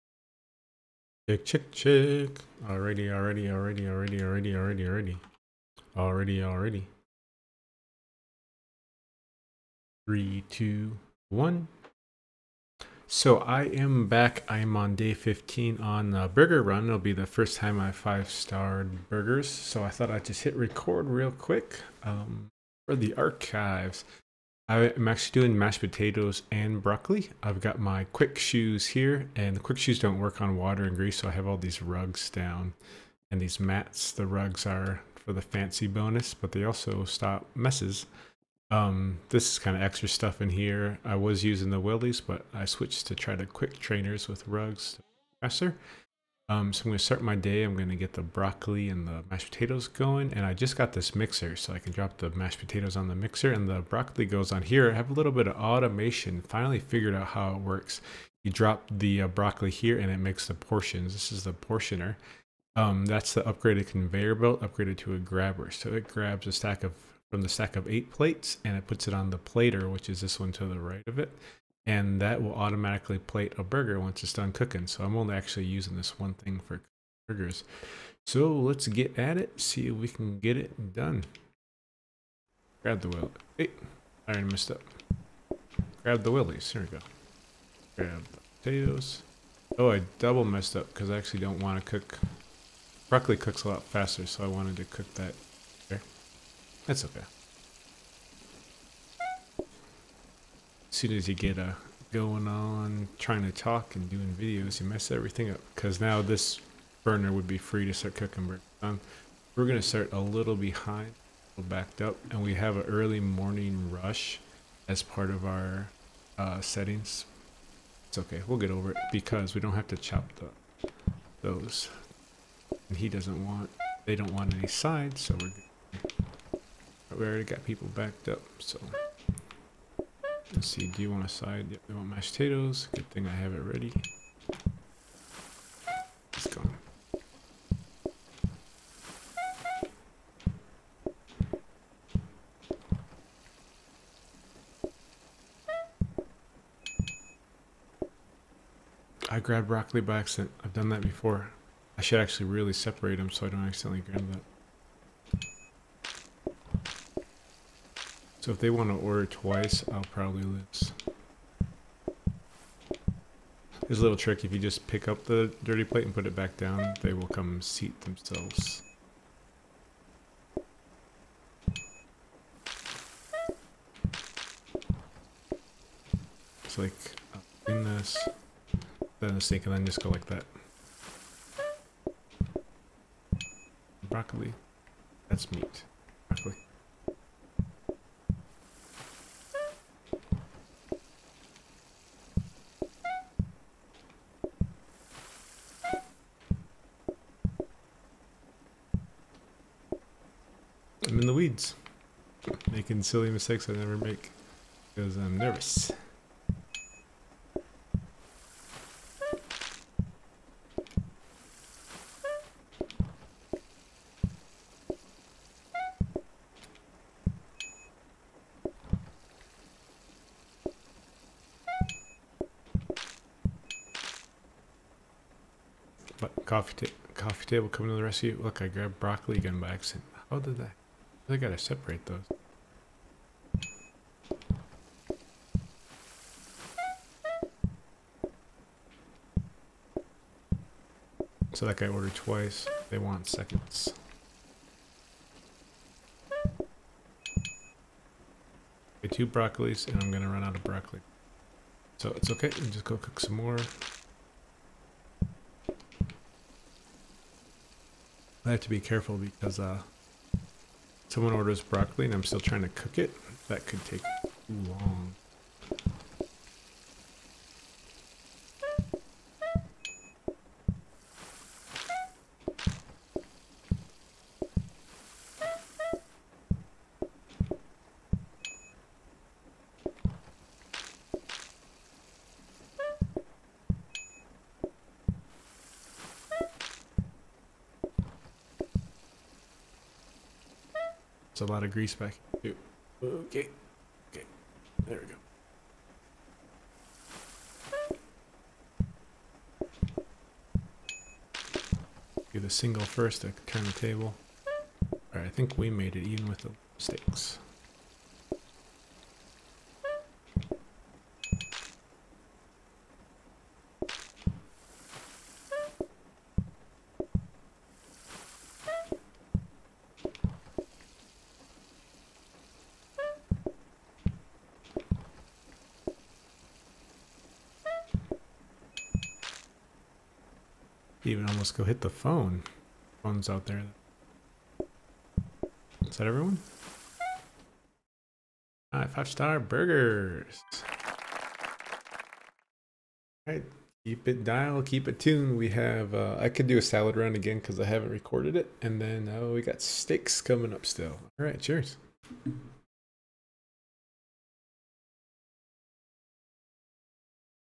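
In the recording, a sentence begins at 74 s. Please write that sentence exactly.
So I'm only actually using this one thing for burgers.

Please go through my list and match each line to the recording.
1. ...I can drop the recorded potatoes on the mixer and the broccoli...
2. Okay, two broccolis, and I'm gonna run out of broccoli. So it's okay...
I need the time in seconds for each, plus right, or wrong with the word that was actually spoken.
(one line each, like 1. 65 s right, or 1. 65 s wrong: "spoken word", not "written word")
1. 51 s wrong: "mashed", not "recorded"
2. 246 s right.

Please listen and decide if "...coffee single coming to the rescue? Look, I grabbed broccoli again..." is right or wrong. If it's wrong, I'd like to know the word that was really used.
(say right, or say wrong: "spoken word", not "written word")
wrong: "table", not "single".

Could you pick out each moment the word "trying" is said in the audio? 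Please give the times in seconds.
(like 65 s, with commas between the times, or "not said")
103 s, 262 s.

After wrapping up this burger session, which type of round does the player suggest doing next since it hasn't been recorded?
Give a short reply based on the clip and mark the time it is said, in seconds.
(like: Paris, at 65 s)
salad, at 346 s.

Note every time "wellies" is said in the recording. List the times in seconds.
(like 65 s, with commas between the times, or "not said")
41 s, 86 s.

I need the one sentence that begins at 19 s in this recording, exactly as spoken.
So I thought I'd just hit record real quick um, for the archives.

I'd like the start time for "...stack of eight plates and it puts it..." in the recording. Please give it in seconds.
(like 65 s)
67 s.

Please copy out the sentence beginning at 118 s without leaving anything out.
It's okay, we'll get over it because we don't have to chop the, those.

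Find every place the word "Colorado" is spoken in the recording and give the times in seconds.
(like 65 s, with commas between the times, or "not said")
not said.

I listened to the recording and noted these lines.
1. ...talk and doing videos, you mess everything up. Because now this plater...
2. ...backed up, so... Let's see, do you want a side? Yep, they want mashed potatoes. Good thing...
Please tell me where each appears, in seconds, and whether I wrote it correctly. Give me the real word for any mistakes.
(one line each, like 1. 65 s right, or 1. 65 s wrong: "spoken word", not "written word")
1. 103 s wrong: "burner", not "plater"
2. 127 s right.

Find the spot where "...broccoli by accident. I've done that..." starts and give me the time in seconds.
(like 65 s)
149 s.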